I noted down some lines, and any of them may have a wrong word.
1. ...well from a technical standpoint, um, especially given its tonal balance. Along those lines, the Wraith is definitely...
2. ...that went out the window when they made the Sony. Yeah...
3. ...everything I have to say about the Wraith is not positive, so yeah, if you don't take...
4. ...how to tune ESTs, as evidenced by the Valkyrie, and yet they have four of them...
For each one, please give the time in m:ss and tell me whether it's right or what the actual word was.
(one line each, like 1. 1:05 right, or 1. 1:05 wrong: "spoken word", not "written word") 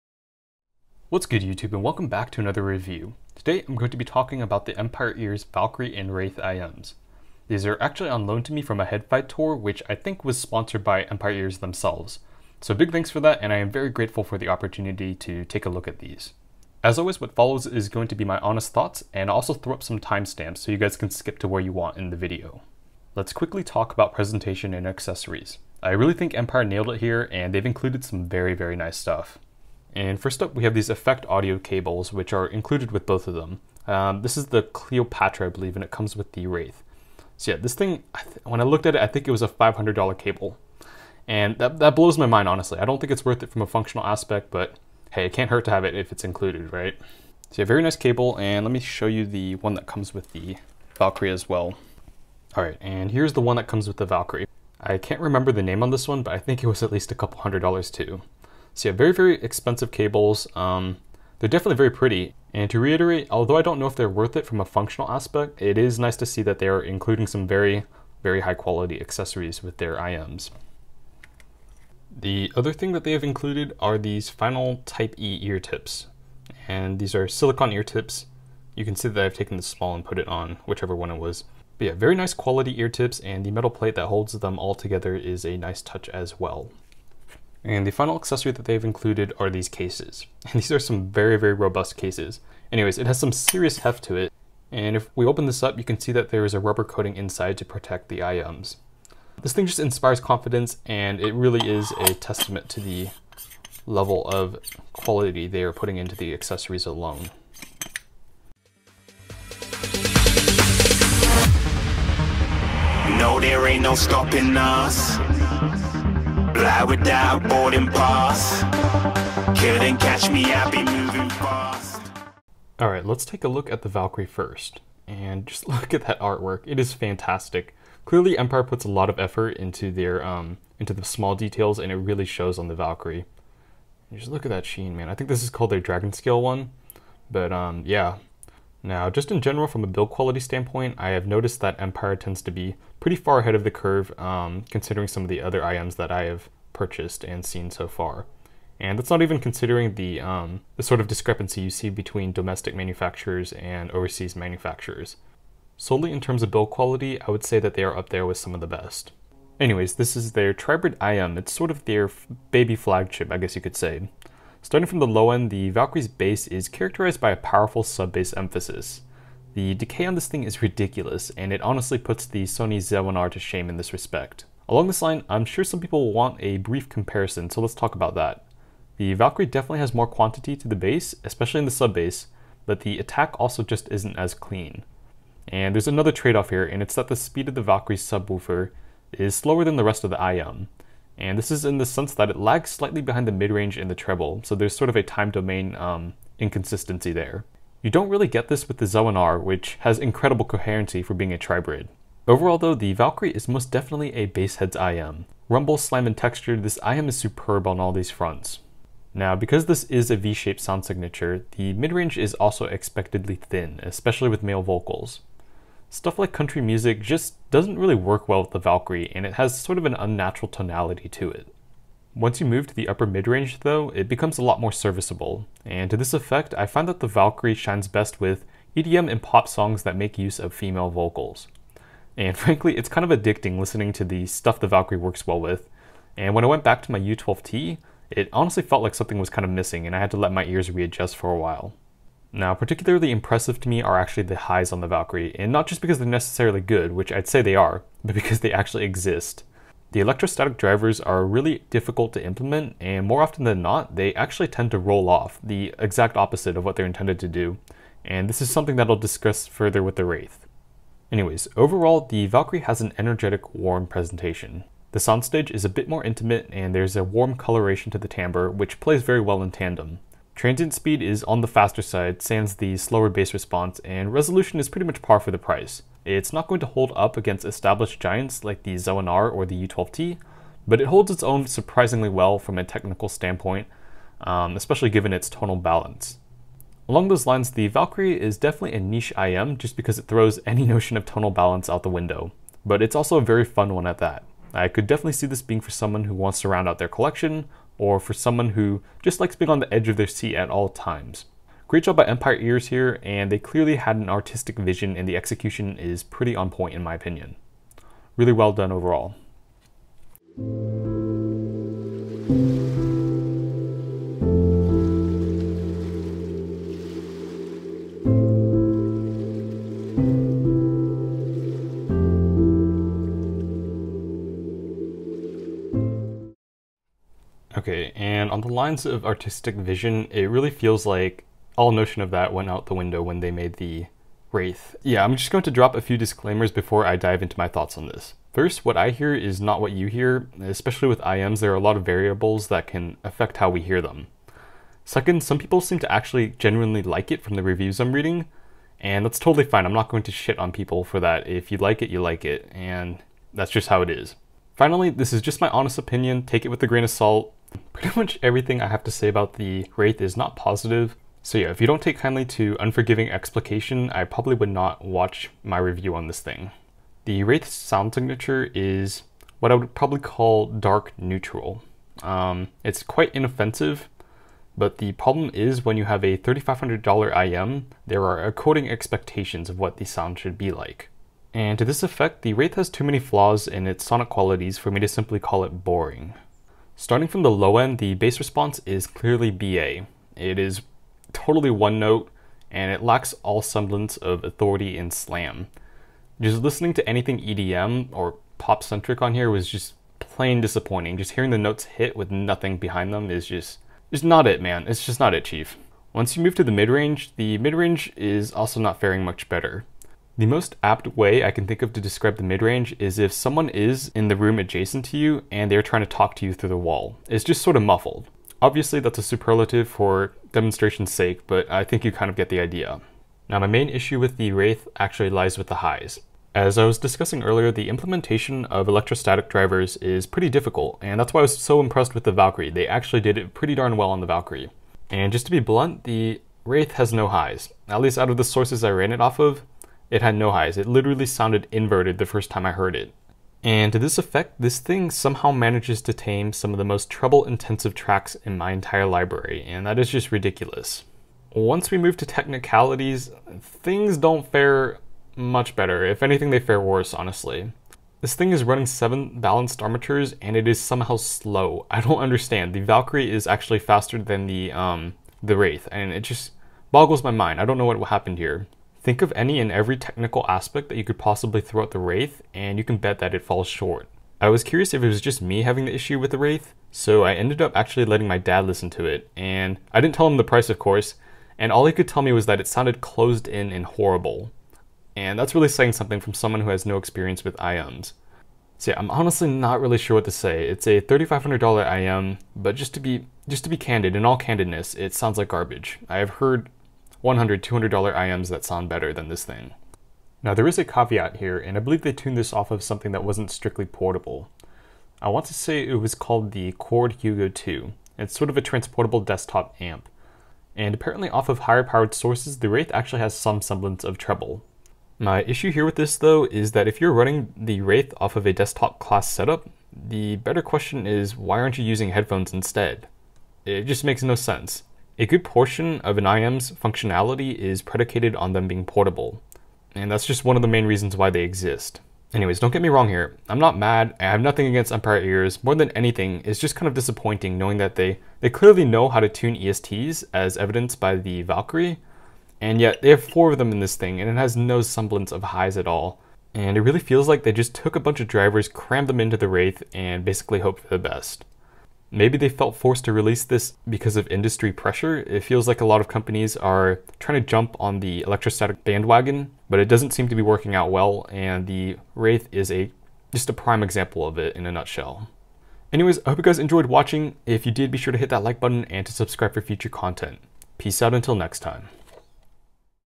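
1. 4:42 wrong: "Valkyrie", not "Wraith"
2. 5:32 wrong: "Wraith", not "Sony"
3. 5:58 right
4. 8:58 right.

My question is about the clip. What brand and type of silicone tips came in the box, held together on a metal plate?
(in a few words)
Final Type E.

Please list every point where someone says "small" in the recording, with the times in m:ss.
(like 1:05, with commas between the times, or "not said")
1:19, 2:11.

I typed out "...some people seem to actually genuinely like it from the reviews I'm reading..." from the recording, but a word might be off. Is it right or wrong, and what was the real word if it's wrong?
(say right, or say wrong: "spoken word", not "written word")
right.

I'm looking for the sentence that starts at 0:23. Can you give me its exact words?
Let's quickly talk about presentation and accessories.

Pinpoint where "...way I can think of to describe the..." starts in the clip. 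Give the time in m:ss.
6:50.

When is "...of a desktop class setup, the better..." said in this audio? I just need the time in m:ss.
8:38.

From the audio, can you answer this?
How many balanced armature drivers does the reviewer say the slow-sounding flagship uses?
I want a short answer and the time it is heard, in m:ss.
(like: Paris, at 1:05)
7, at 7:38.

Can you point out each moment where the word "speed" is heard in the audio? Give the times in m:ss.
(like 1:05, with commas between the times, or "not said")
3:07, 4:30.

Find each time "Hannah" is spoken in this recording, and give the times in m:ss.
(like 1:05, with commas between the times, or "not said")
not said.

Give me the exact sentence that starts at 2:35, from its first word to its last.
Solely in terms of build quality, I would say that they are up there with some of the best.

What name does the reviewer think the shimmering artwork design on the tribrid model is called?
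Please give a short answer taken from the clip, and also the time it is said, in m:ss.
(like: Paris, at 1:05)
Dragon Scale, at 2:15.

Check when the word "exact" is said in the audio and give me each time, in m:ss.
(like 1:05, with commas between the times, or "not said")
4:15.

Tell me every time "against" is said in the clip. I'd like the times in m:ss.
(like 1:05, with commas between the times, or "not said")
4:37, 8:54.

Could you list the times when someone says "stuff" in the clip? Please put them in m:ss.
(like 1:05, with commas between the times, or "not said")
0:28, 3:35, 3:54.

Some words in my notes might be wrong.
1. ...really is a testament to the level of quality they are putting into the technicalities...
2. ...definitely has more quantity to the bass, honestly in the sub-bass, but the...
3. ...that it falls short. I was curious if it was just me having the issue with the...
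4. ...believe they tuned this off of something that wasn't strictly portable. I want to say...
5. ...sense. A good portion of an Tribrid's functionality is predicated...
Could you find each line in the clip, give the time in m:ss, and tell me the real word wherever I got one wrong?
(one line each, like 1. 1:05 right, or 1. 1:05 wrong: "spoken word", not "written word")
1. 1:41 wrong: "accessories", not "technicalities"
2. 2:59 wrong: "especially", not "honestly"
3. 7:52 right
4. 8:21 right
5. 8:44 wrong: "IEM", not "Tribrid".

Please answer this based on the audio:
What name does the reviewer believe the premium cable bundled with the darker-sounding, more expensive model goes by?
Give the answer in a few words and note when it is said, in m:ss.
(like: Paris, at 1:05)
Cleopatra, at 0:34.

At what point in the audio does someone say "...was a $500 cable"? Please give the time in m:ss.
0:39.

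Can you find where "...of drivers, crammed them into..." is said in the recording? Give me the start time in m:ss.
9:08.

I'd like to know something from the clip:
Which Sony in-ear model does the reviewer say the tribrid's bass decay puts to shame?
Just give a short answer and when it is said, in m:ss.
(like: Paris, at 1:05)
Sony Z1R, at 2:52.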